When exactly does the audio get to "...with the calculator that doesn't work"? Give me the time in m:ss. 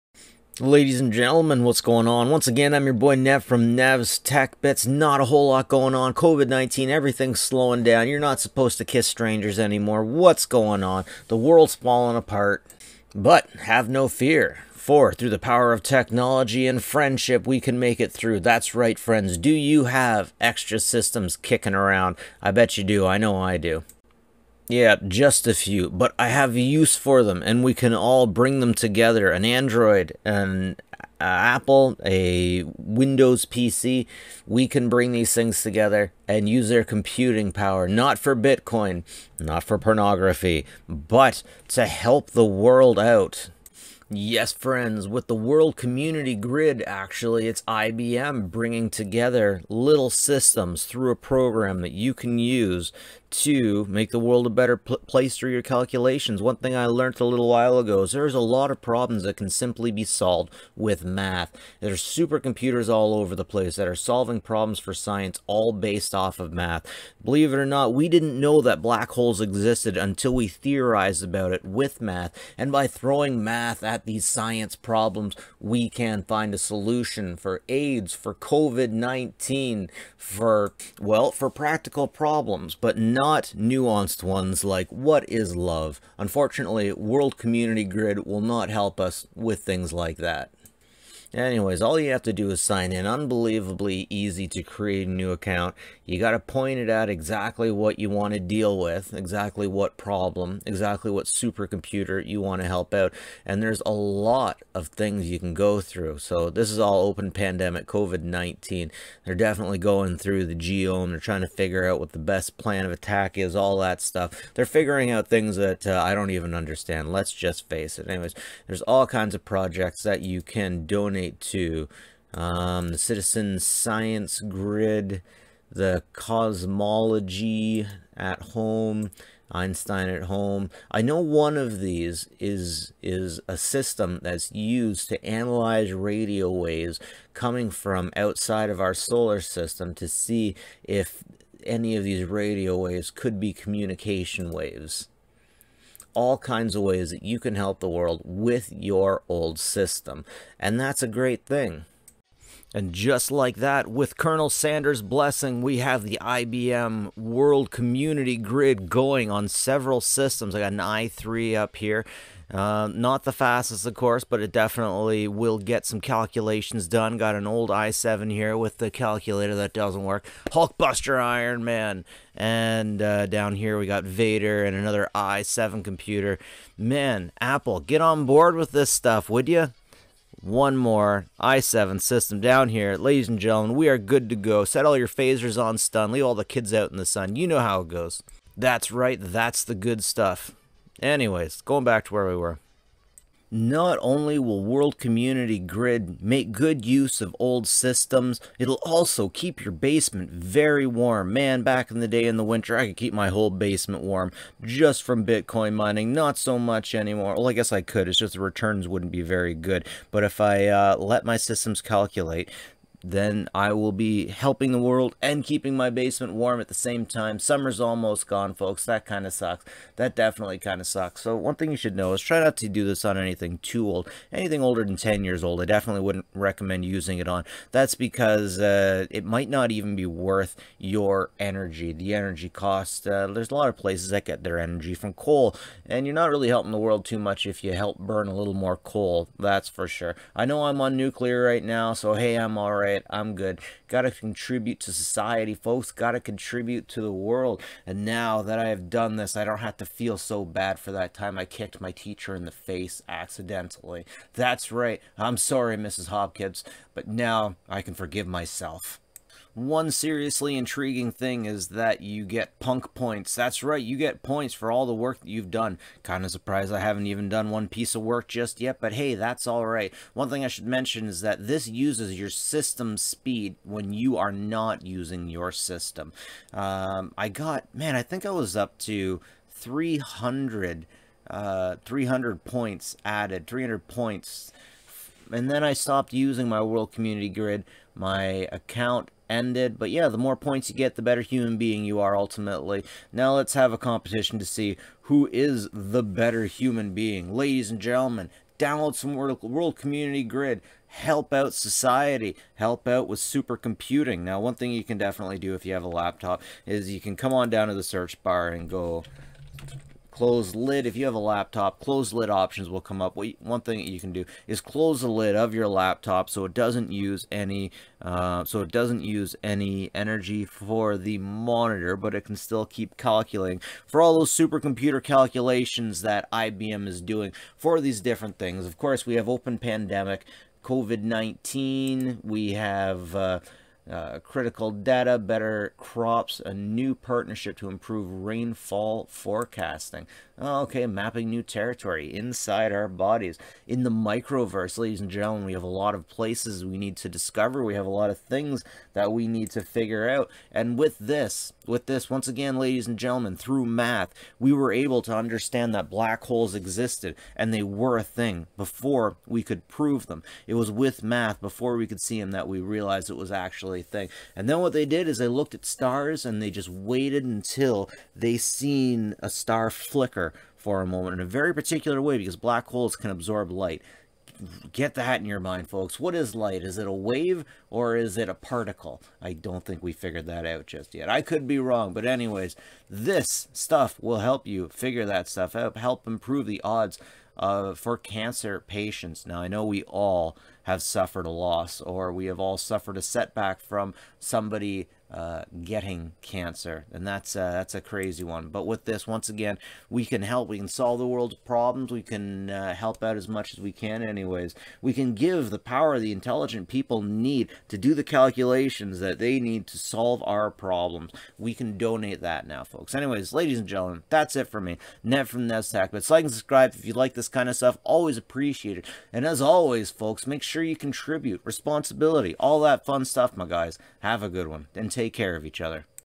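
2:48.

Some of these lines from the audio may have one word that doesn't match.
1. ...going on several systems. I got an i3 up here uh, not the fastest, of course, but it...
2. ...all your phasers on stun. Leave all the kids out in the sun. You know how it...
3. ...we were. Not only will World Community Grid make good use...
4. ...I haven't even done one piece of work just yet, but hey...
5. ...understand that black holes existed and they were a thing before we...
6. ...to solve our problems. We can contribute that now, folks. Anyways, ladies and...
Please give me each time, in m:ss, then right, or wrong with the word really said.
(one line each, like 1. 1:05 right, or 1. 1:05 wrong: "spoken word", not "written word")
1. 2:38 right
2. 3:04 right
3. 3:12 right
4. 4:26 right
5. 5:55 right
6. 6:49 wrong: "donate", not "contribute".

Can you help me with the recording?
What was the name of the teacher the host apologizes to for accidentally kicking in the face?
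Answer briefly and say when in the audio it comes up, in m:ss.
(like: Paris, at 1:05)
Mrs. Hopkins, at 4:15.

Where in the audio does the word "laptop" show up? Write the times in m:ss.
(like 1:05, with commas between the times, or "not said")
5:05, 5:11, 5:15.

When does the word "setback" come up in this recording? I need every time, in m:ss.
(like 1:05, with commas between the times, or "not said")
6:33.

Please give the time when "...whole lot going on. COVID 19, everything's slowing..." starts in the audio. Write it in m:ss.
0:05.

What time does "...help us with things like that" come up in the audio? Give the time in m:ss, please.
1:28.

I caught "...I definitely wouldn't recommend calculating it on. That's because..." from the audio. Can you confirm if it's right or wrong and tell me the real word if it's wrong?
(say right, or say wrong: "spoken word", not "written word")
wrong: "using", not "calculating".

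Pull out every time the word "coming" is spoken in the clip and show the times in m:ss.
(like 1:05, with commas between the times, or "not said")
2:17.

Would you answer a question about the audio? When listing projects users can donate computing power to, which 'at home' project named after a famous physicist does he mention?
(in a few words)
Einstein at home.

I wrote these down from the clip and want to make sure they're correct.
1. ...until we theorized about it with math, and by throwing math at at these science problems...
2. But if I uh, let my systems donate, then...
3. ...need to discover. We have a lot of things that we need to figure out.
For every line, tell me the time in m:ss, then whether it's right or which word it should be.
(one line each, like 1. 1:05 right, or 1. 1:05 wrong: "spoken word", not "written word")
1. 1:09 right
2. 3:30 wrong: "calculate", not "donate"
3. 5:46 right.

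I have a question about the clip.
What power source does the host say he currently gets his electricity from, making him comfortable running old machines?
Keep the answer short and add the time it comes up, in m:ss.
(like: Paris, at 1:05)
Nuclear, at 4:00.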